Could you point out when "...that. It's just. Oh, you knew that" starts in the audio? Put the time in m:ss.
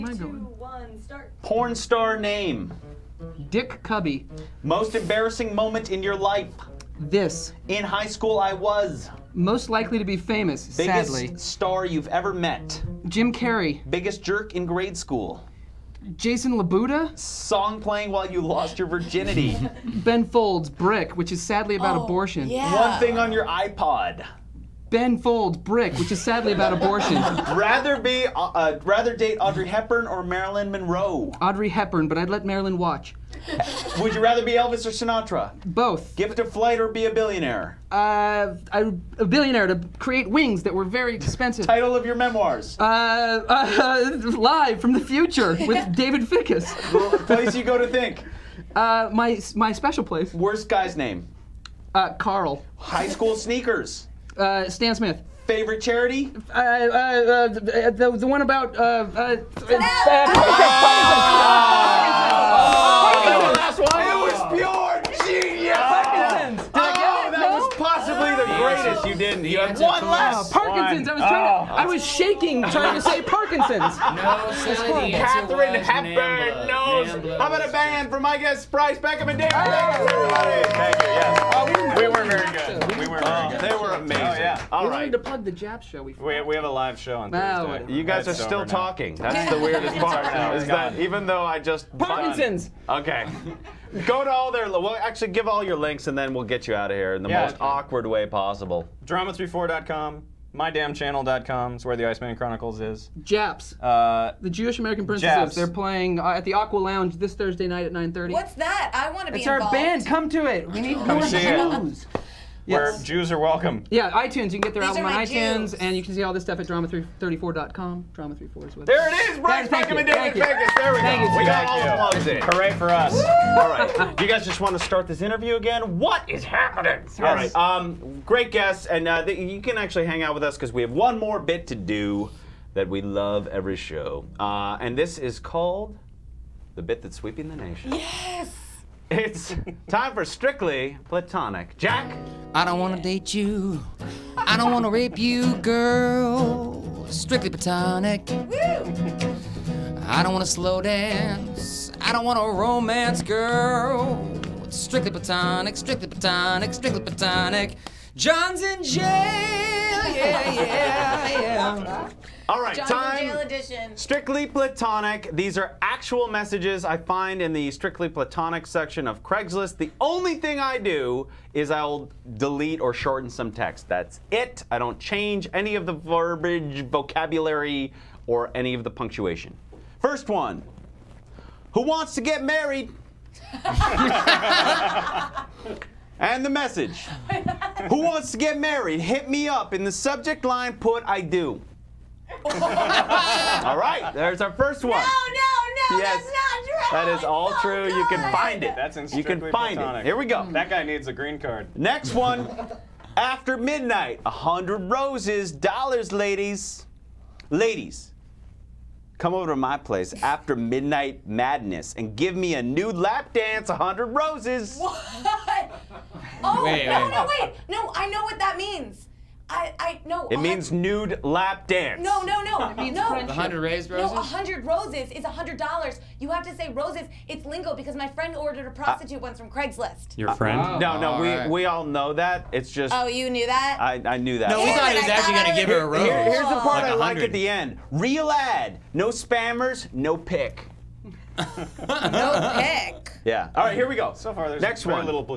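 3:52.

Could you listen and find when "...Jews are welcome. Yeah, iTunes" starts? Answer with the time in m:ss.
1:53.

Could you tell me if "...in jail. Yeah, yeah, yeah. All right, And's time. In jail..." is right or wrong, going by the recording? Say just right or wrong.
wrong.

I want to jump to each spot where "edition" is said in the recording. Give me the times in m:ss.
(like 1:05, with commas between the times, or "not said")
2:43.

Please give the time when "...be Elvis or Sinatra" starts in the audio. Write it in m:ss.
0:34.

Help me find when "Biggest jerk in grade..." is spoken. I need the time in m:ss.
0:13.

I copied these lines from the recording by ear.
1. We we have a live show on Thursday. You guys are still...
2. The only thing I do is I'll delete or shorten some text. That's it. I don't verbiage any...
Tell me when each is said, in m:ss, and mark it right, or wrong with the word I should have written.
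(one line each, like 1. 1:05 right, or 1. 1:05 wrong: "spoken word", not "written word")
1. 1:26 right
2. 2:49 wrong: "change", not "verbiage".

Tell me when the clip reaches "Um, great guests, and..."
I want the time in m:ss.
2:07.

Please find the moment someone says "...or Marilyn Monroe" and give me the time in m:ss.
0:30.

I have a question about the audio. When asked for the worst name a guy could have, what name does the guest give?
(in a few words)
Carl.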